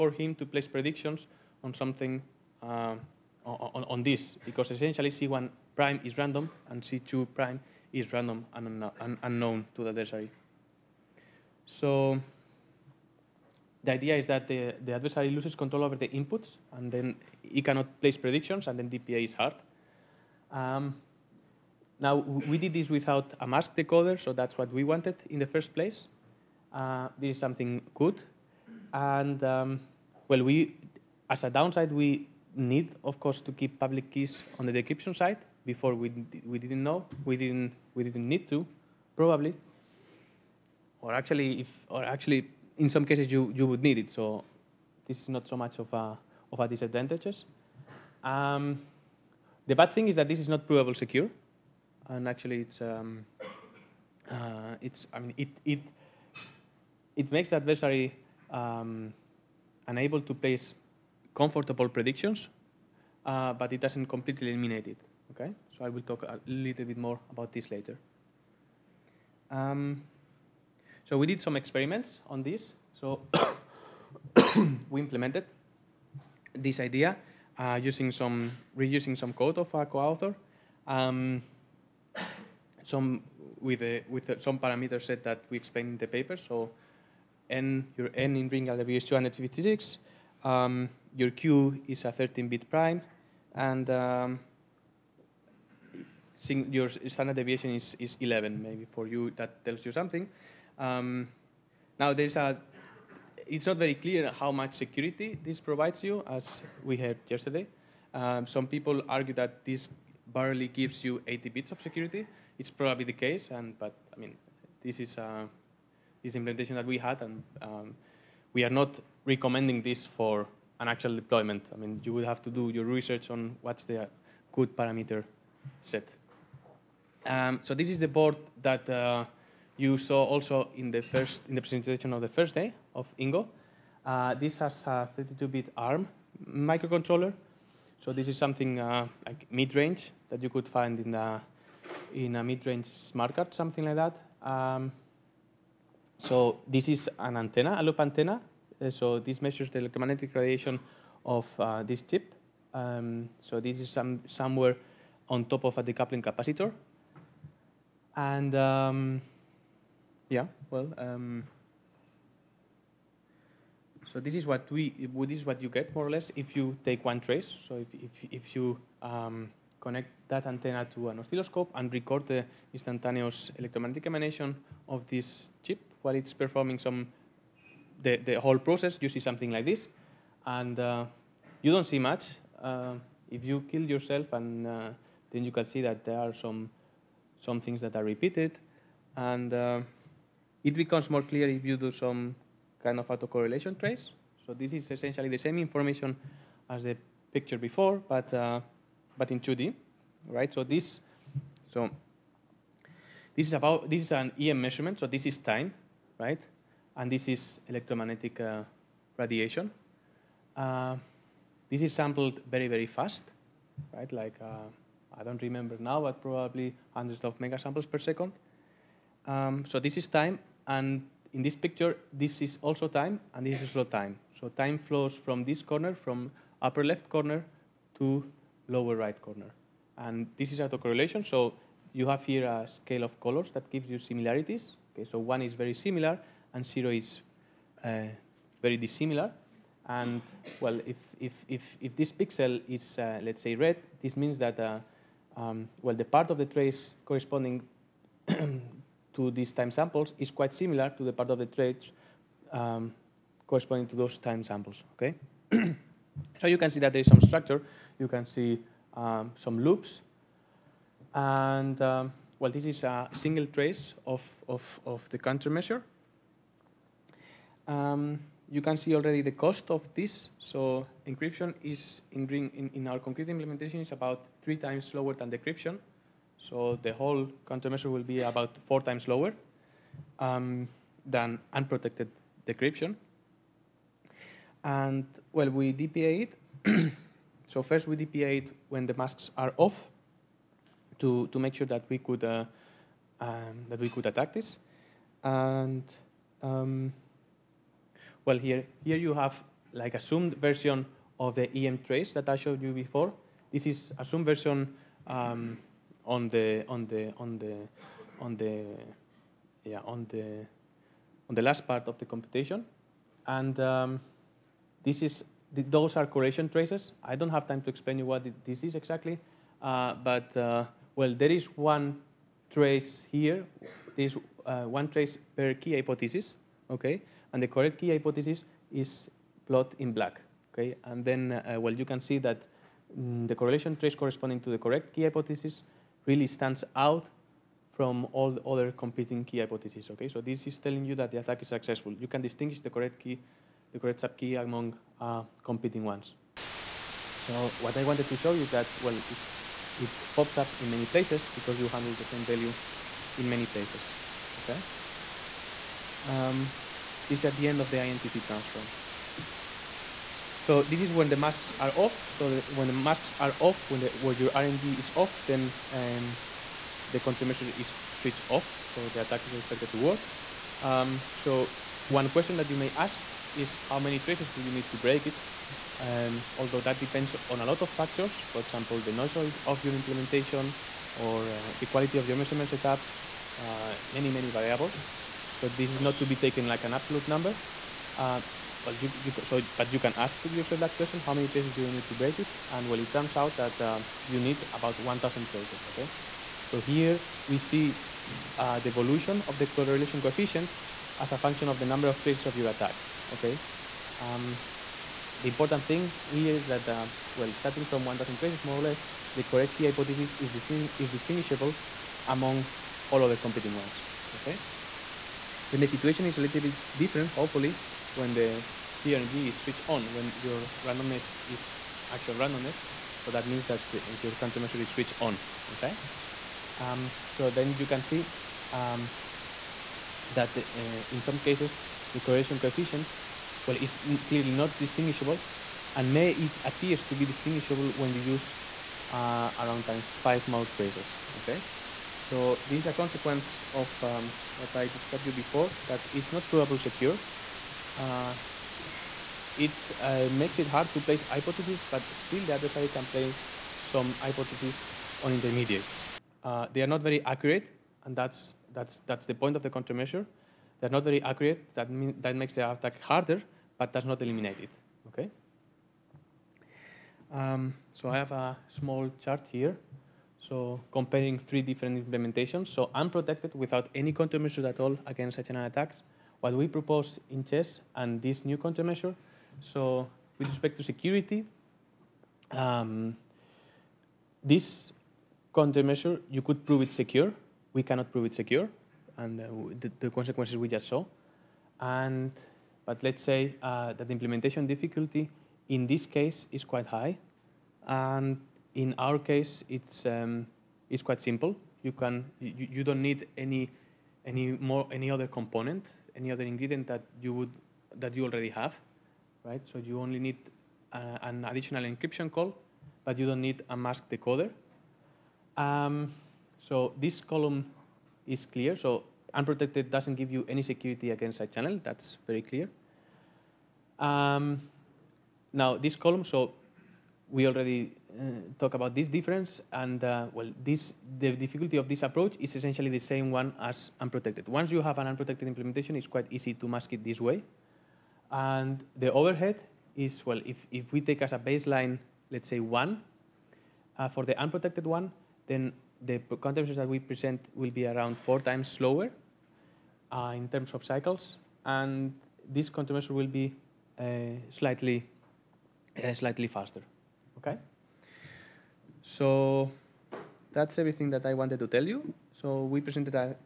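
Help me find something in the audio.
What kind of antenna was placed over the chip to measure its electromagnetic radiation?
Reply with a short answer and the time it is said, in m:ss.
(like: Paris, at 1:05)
A loop antenna, at 2:27.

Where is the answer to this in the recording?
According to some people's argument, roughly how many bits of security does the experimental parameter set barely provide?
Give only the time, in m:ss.
1:51.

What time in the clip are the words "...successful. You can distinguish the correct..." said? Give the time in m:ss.
5:41.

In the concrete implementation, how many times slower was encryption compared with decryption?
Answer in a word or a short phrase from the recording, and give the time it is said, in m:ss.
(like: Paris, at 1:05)
3, at 4:34.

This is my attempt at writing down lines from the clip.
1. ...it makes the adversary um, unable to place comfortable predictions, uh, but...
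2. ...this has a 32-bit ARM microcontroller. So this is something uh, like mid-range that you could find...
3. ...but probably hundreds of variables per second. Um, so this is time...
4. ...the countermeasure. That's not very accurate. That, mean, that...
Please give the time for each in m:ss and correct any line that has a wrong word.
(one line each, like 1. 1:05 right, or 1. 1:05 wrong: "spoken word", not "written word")
1. 0:57 right
2. 2:14 right
3. 3:36 wrong: "megasamples", not "variables"
4. 7:39 right.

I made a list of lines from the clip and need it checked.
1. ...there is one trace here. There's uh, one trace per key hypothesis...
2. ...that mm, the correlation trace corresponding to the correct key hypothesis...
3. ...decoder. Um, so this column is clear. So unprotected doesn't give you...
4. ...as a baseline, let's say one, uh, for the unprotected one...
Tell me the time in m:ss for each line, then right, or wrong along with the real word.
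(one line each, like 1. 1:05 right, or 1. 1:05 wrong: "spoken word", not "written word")
1. 5:21 right
2. 5:32 right
3. 8:33 right
4. 9:01 right.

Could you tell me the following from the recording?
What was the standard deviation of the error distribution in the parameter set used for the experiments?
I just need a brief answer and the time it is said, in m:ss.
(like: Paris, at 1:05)
11, at 1:38.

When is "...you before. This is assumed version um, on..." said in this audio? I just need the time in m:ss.
5:02.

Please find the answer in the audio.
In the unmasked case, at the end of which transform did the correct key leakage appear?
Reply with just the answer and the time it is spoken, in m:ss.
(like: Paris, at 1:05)
INTT, at 5:57.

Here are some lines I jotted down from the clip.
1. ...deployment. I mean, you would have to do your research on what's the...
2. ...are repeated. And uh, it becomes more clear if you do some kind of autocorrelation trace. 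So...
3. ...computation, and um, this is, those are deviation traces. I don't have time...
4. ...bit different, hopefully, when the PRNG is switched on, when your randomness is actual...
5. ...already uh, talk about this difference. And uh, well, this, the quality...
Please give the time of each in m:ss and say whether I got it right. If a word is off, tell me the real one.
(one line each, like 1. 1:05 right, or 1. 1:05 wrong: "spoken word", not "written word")
1. 2:01 right
2. 3:07 right
3. 5:12 wrong: "correlation", not "deviation"
4. 6:56 right
5. 8:47 wrong: "difficulty", not "quality".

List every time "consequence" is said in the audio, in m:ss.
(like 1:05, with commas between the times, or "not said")
7:22, 8:09.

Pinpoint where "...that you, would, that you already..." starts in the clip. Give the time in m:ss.
8:26.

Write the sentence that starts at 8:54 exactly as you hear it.
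Once you have an unprotected implementation, it's quite easy to mask it this way.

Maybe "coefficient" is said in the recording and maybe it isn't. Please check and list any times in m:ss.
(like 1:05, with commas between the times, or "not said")
6:39, 7:12.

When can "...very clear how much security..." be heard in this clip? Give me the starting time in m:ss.
1:43.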